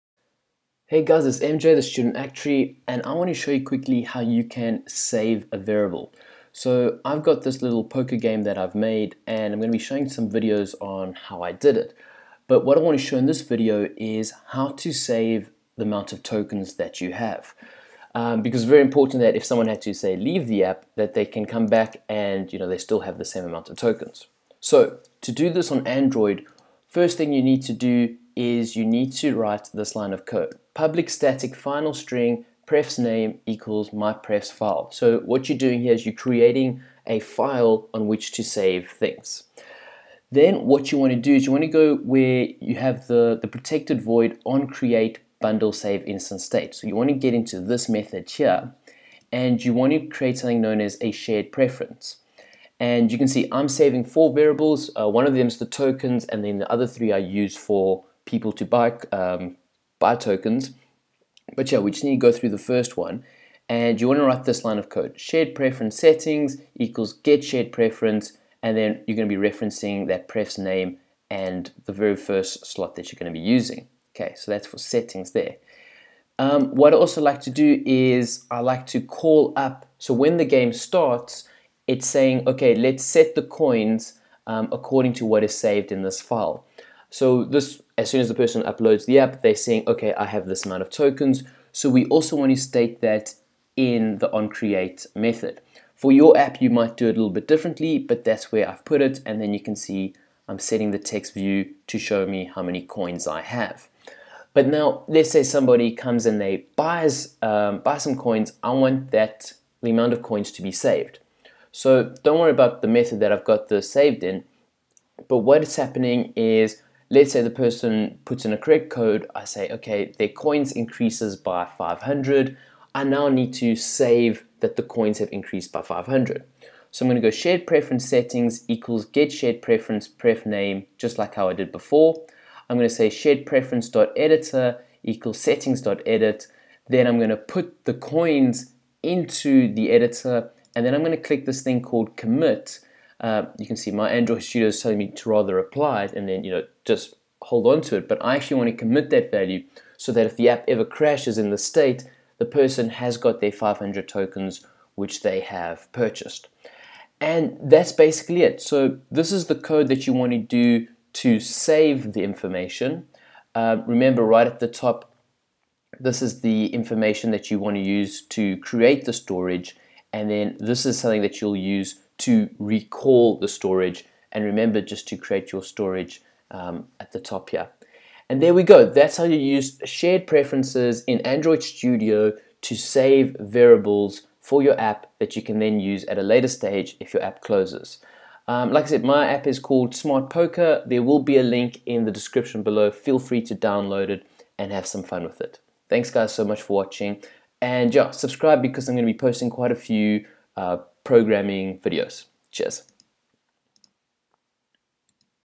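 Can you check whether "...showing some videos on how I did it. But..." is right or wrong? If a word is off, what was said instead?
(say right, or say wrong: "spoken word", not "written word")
right.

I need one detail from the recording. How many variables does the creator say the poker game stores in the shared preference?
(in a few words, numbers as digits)
4.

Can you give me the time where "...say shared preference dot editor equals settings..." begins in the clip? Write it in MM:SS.
02:12.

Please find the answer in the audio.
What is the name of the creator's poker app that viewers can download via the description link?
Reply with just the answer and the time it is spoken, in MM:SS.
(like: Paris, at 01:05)
Smart Poker, at 03:09.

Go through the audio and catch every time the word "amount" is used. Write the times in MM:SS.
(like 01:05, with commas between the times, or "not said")
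00:15, 00:23, 01:30, 01:49.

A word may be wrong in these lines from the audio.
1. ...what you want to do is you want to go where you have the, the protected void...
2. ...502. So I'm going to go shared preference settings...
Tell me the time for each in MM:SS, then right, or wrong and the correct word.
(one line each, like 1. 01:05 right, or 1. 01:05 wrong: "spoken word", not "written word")
1. 00:40 right
2. 02:05 wrong: "500", not "502".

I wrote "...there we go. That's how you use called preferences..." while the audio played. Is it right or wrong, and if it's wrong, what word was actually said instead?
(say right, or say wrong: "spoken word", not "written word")
wrong: "shared", not "called".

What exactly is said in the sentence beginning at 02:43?
Uh, remember right at the top, this is the information that you want to use to create the storage.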